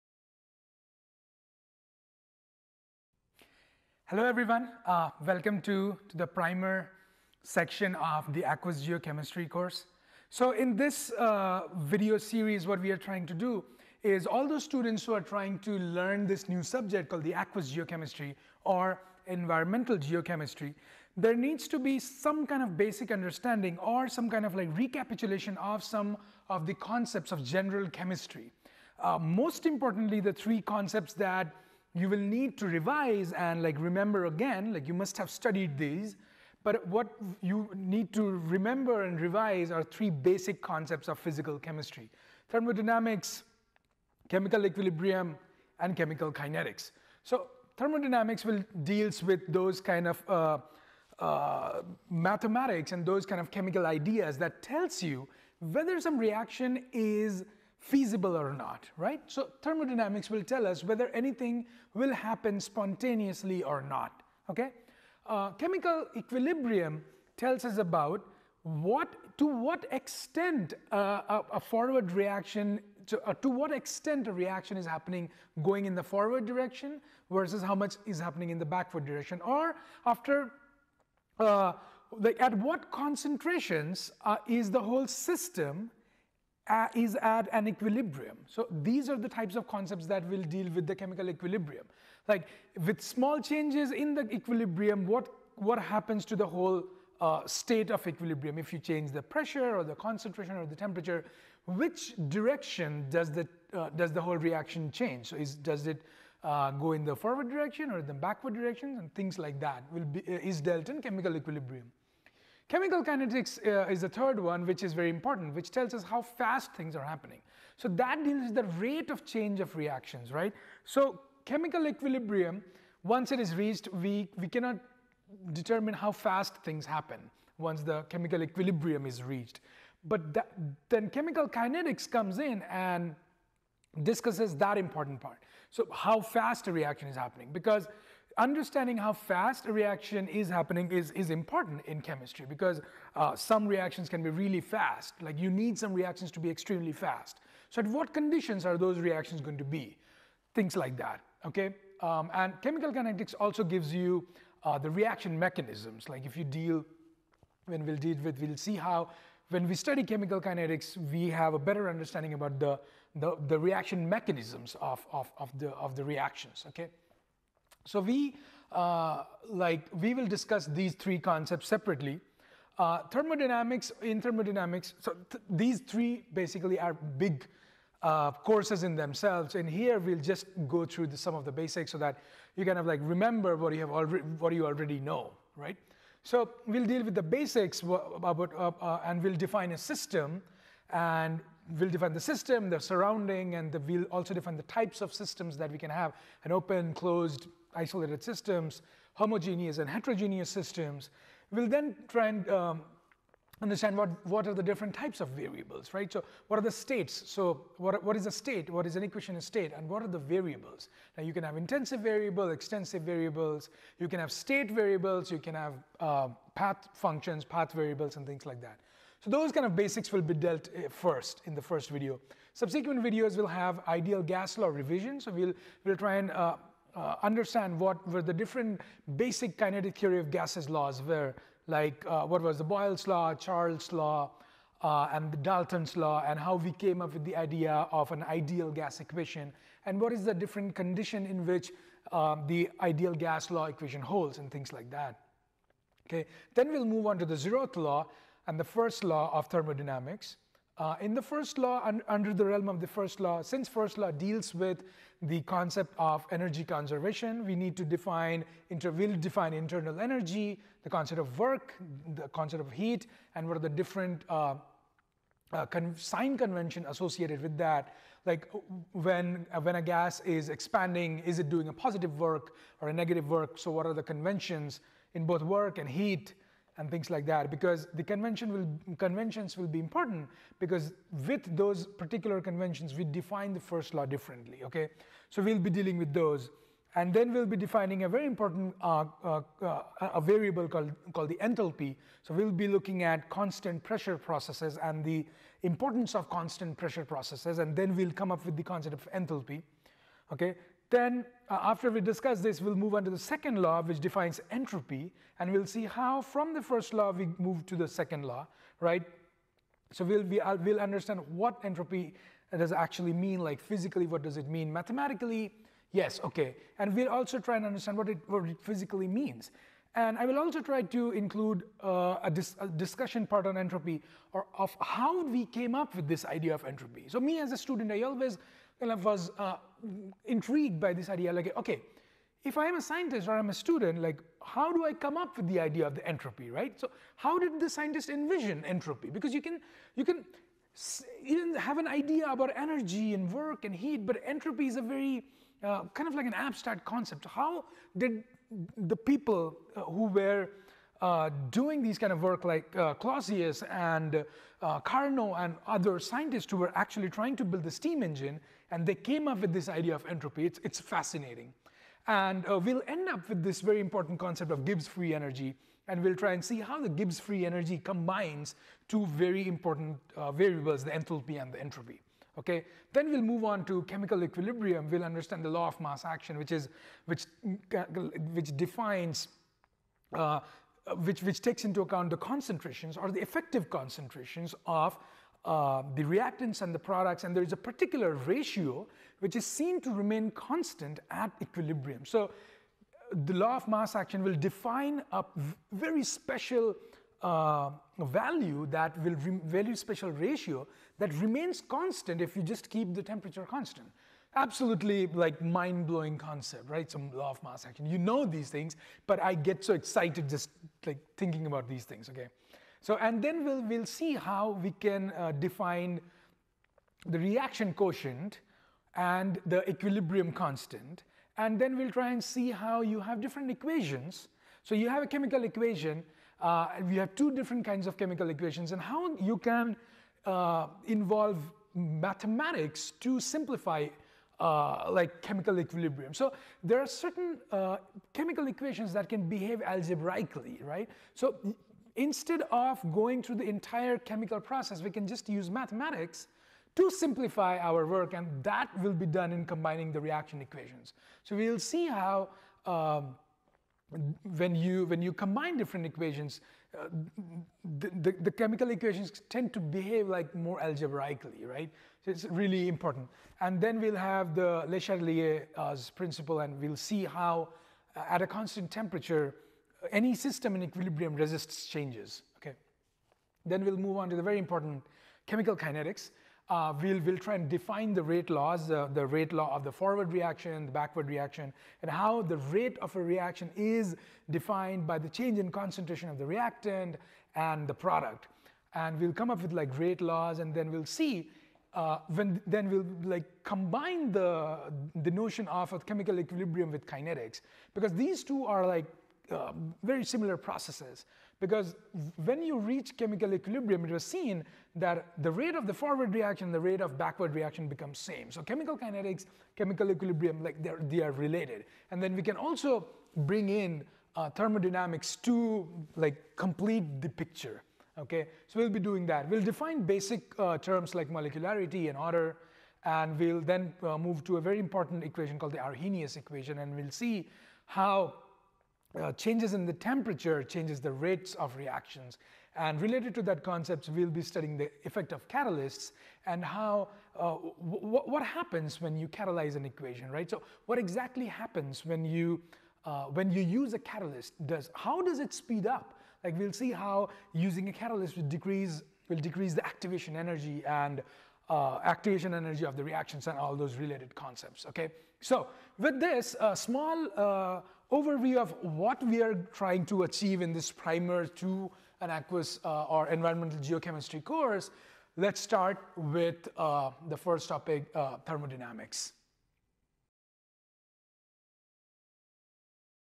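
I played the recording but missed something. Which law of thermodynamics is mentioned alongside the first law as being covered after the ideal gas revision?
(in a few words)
Zeroth law.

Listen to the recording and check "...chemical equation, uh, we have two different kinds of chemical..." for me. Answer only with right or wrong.
right.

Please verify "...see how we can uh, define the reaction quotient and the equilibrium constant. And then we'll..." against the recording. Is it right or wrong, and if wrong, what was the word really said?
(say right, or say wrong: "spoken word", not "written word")
right.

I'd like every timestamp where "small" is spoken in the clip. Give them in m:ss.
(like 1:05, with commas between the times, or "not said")
1:33, 9:16.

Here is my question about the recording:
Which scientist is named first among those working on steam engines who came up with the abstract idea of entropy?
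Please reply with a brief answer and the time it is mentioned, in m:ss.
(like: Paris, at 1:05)
Clausius, at 5:52.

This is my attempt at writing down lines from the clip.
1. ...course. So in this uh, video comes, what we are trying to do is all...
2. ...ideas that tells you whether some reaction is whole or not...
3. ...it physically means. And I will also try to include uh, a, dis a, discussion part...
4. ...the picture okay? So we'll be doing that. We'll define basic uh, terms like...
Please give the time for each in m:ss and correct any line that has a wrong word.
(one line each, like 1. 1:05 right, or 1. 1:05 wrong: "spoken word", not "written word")
1. 0:09 wrong: "series", not "comes"
2. 0:53 wrong: "feasible", not "whole"
3. 5:18 right
4. 8:37 right.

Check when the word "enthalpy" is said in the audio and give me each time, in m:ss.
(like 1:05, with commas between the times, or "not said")
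4:51, 4:59, 6:10.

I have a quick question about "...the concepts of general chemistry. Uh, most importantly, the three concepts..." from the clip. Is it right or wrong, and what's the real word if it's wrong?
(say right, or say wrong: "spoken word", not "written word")
right.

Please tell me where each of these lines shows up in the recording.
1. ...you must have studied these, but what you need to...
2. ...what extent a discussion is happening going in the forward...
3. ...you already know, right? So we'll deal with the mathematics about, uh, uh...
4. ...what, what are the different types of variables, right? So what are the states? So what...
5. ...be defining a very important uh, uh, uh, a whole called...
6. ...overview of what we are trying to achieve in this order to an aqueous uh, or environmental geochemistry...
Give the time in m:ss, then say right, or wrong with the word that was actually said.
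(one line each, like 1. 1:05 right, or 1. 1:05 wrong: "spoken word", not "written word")
1. 0:34 right
2. 1:13 wrong: "reaction", not "discussion"
3. 3:04 wrong: "basics", not "mathematics"
4. 3:23 right
5. 4:47 wrong: "variable", not "whole"
6. 9:17 wrong: "primer", not "order".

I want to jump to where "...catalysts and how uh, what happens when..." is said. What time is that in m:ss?
8:55.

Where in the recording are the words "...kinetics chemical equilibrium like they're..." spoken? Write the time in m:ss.
8:28.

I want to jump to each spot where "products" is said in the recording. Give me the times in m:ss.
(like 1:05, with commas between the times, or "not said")
6:26, 8:07.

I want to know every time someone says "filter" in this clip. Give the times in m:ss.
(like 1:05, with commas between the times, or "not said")
not said.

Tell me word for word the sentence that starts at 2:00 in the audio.
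So chemical equilibrium, once it is reached, we, we cannot determine how fast things happen once the chemical equilibrium is reached.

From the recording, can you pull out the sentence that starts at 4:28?
Like when, when a gas is expanding, is it doing a positive work or a negative work?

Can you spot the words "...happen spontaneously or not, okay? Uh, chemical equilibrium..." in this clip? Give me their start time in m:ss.
1:02.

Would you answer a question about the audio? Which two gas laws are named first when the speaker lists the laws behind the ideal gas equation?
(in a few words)
Boyle's law, Charles' law.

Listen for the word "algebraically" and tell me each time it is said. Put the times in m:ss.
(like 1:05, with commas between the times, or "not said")
7:19, 7:40.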